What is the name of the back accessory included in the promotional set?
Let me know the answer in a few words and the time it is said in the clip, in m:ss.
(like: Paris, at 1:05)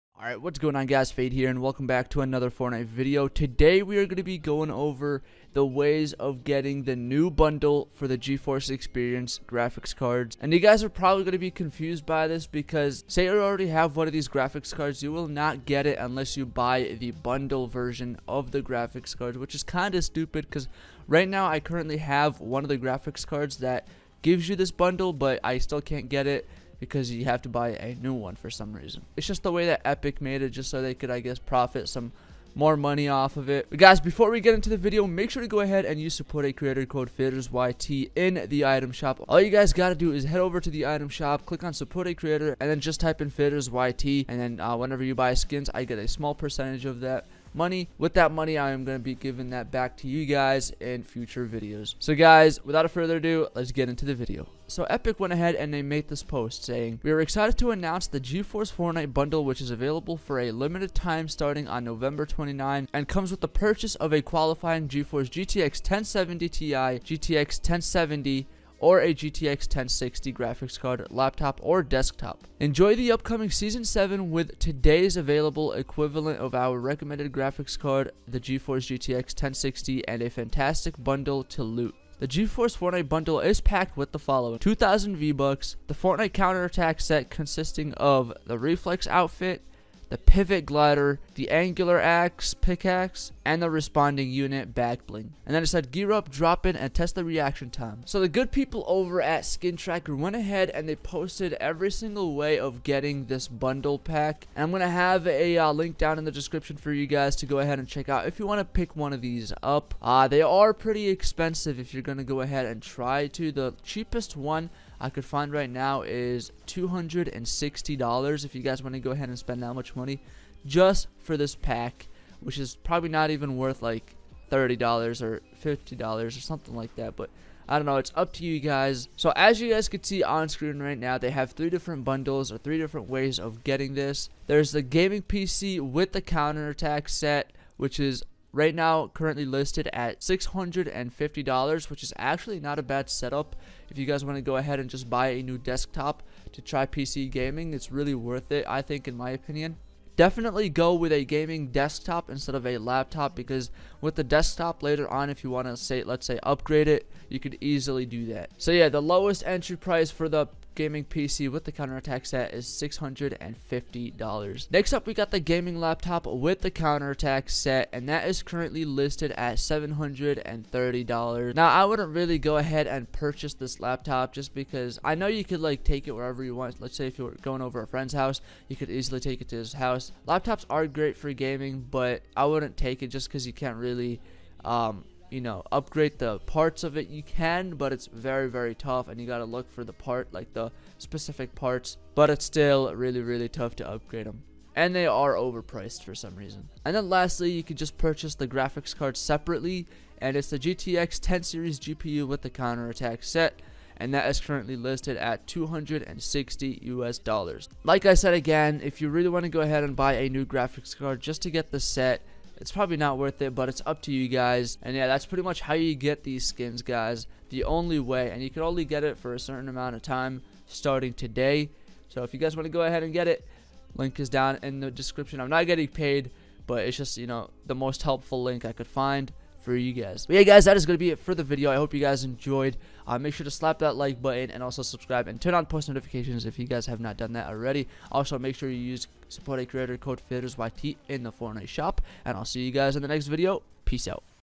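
Response Unit, at 1:33.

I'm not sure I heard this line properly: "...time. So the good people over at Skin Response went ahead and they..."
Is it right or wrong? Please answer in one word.
wrong.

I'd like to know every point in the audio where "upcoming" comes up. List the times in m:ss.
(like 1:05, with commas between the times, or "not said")
1:13.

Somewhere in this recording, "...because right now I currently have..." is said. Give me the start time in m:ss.
0:20.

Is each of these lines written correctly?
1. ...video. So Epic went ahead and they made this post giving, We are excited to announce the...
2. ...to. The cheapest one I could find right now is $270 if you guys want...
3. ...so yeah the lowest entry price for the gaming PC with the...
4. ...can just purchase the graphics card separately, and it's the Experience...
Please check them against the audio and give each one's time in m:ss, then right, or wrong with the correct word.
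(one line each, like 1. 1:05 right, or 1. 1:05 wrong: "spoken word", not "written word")
1. 0:54 wrong: "saying", not "giving"
2. 1:53 wrong: "260", not "270"
3. 2:38 right
4. 3:17 wrong: "GTX", not "Experience".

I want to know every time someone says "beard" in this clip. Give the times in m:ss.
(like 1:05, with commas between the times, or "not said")
not said.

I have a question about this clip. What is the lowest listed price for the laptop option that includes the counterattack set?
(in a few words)
$730.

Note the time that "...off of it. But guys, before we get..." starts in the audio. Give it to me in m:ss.
0:33.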